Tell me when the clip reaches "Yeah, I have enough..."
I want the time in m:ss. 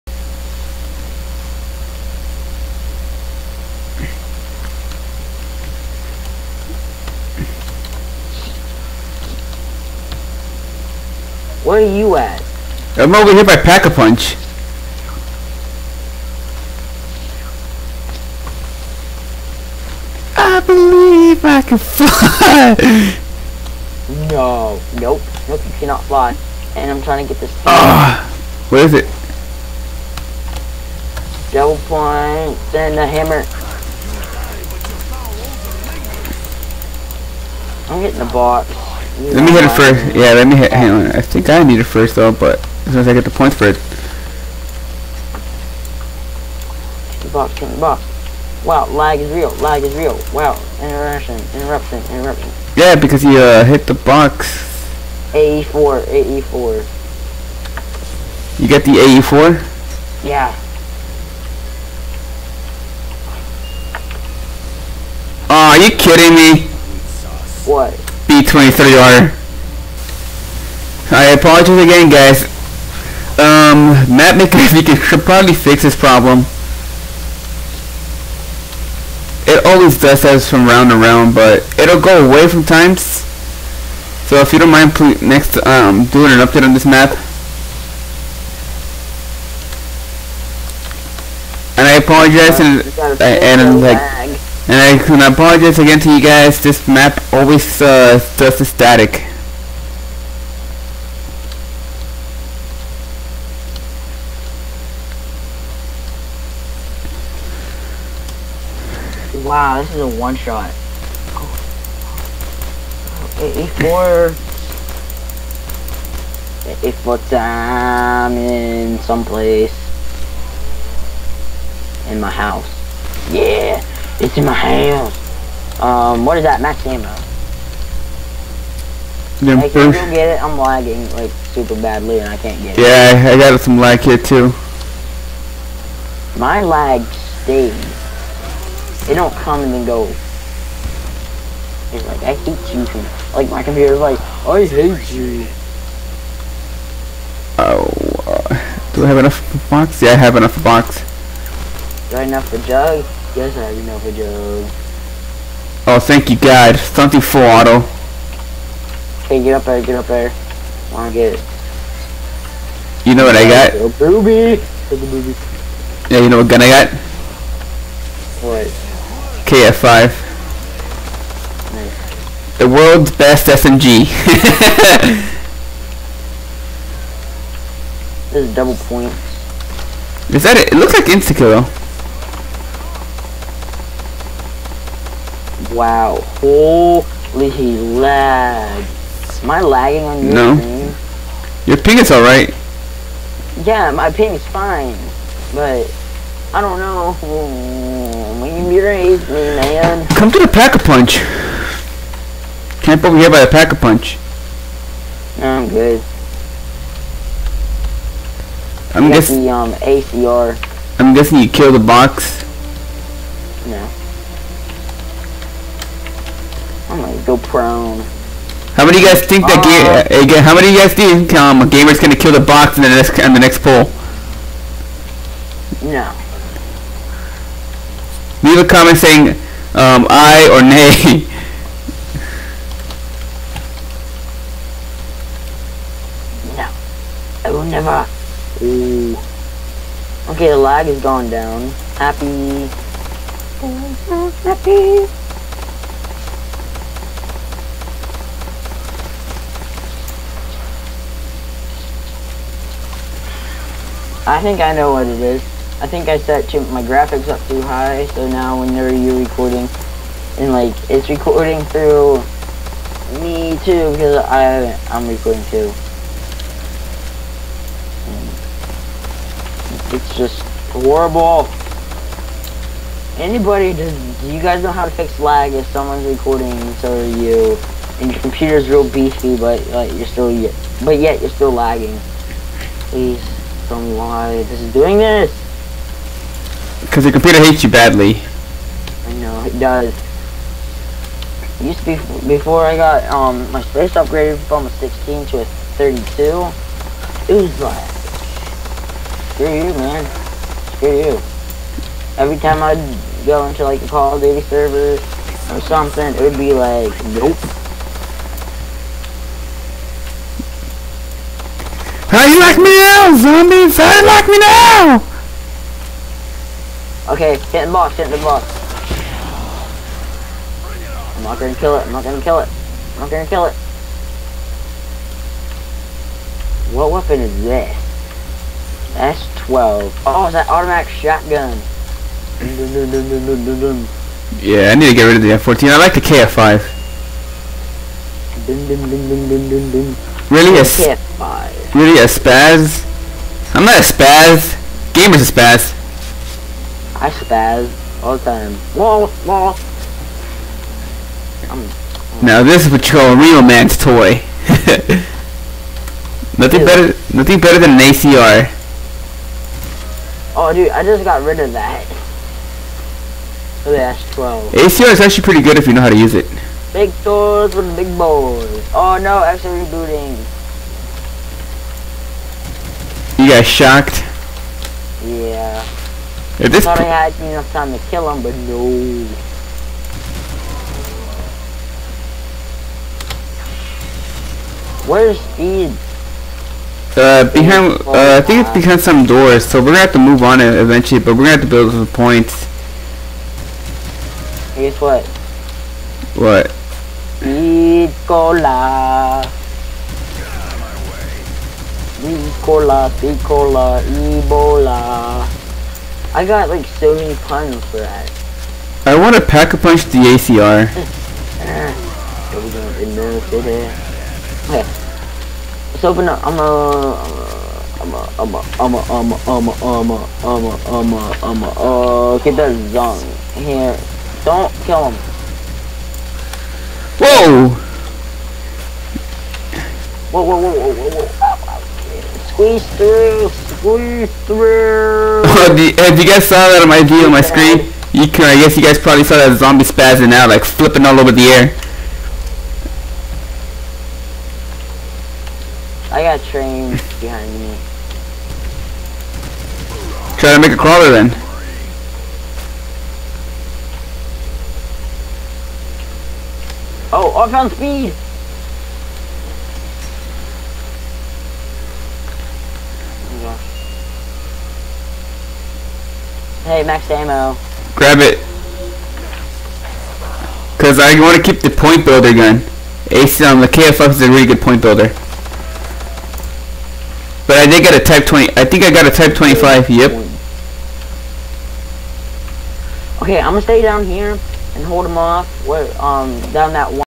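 2:29.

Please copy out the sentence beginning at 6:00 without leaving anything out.
Oh dude, I just got rid of that.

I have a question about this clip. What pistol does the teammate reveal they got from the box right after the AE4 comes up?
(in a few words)
B23R.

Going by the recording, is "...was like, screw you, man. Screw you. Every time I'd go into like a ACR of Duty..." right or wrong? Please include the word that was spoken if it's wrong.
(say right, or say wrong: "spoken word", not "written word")
wrong: "Call", not "ACR".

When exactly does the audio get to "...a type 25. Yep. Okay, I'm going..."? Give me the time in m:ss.
7:58.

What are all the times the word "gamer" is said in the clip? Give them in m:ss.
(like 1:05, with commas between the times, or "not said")
3:41, 5:44.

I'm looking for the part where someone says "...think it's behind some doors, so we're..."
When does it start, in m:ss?
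6:28.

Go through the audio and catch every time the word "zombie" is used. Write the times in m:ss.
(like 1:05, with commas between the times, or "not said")
5:13, 7:19.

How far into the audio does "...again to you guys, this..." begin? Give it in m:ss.
1:35.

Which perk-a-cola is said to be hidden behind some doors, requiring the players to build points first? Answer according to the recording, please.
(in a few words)
Speed Cola.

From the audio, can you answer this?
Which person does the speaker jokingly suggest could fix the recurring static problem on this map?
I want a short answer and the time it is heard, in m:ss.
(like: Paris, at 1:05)
Matt McAfee, at 1:14.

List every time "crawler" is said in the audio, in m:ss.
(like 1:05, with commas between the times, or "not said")
7:30.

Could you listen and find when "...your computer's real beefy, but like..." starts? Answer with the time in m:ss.
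4:38.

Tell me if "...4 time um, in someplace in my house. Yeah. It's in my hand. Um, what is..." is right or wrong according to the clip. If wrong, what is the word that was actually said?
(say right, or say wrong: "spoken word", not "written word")
right.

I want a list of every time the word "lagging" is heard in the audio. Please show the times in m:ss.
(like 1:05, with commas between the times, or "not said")
2:10, 3:09, 4:41.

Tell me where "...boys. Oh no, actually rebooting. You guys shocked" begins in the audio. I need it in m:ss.
6:07.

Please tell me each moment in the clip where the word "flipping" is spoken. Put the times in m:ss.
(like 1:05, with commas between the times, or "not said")
7:20.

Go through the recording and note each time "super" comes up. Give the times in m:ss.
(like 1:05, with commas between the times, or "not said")
2:11.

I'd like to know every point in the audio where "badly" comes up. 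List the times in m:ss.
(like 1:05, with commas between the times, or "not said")
2:11, 4:47.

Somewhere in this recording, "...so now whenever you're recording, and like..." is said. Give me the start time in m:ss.
4:18.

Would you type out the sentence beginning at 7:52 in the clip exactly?
Ace on um, the KFX is a really good point builder.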